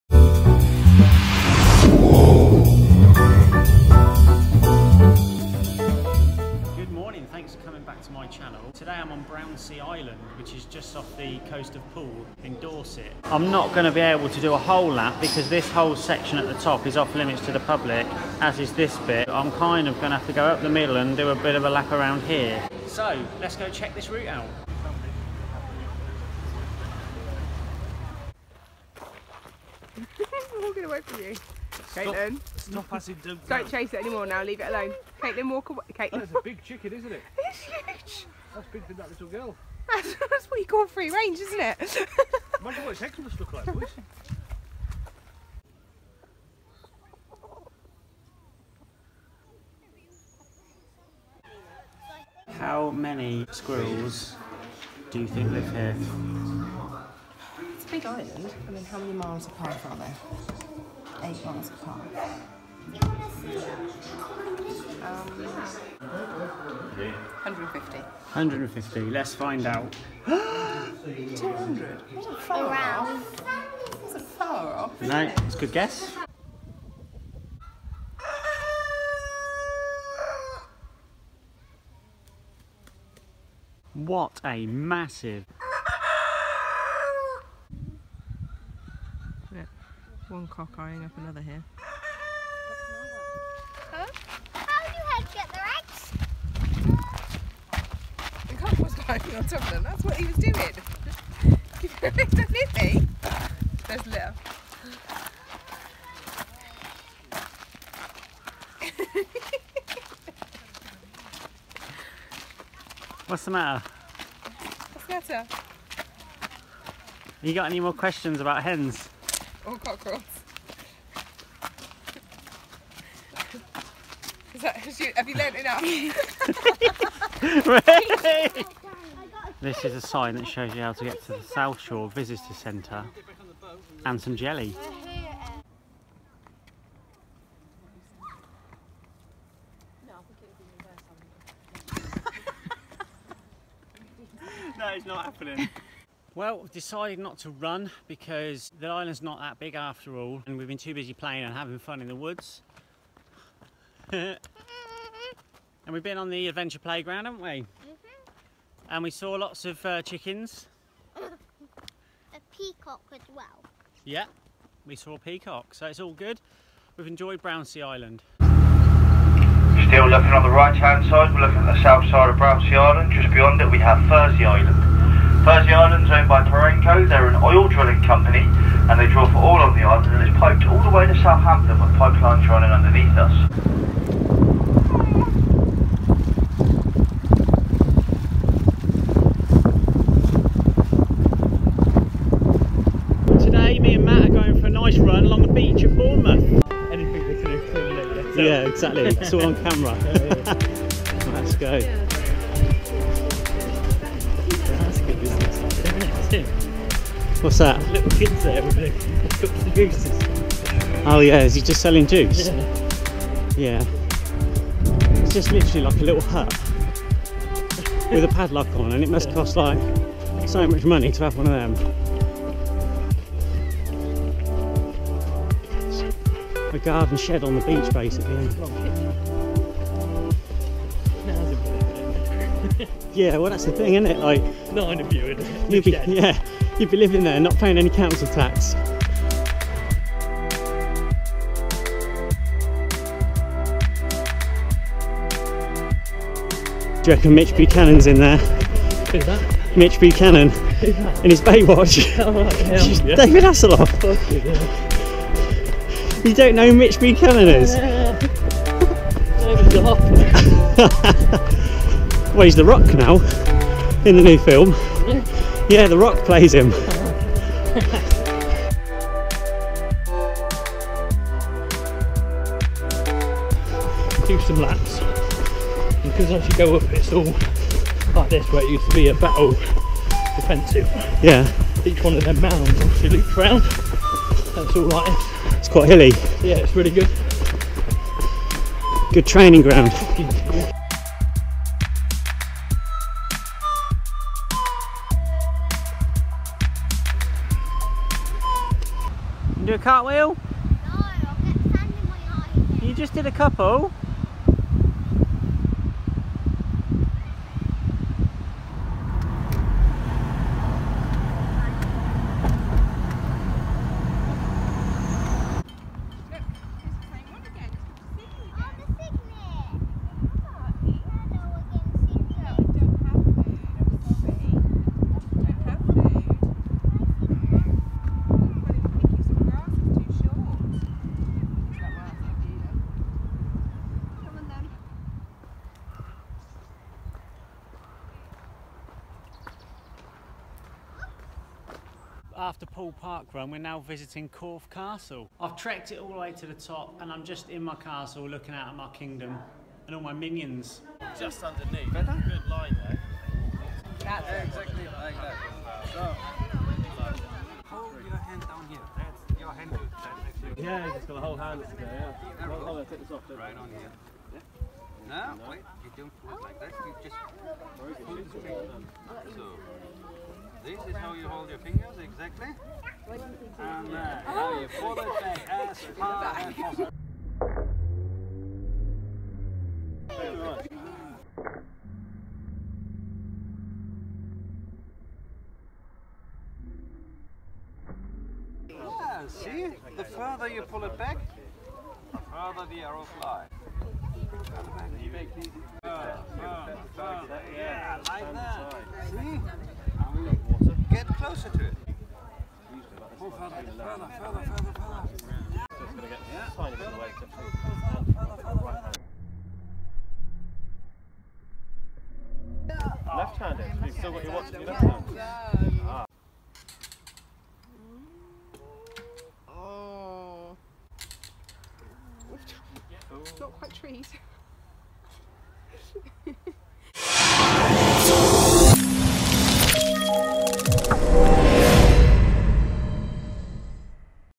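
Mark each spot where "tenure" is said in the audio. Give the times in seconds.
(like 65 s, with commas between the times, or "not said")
not said.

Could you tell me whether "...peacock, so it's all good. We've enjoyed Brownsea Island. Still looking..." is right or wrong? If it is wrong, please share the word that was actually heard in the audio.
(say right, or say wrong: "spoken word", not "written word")
right.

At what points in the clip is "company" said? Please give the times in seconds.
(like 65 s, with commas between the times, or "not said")
178 s.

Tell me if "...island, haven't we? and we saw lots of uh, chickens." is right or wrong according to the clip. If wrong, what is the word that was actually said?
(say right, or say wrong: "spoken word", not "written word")
wrong: "playground", not "island".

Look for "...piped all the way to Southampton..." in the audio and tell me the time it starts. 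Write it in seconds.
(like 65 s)
180 s.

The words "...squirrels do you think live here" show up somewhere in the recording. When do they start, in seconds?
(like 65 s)
53 s.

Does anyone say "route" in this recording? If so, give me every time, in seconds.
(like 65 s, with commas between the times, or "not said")
24 s.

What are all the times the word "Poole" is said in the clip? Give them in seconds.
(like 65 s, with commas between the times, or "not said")
11 s, 342 s.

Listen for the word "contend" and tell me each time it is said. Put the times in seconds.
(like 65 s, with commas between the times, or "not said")
not said.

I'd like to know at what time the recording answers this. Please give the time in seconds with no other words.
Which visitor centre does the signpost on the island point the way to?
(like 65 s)
131 s.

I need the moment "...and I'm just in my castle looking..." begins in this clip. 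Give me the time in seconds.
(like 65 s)
346 s.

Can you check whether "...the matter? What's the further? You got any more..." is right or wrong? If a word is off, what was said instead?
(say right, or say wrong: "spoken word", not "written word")
wrong: "matter", not "further".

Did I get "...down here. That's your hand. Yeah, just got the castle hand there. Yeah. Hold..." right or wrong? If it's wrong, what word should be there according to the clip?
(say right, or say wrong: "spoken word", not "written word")
wrong: "whole", not "castle".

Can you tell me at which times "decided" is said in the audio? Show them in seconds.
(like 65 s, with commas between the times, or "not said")
146 s.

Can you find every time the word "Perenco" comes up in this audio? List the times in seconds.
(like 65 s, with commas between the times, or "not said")
176 s.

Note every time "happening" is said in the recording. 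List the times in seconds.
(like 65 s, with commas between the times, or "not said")
145 s.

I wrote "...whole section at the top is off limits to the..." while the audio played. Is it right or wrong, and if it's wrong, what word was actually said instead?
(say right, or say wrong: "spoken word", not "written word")
right.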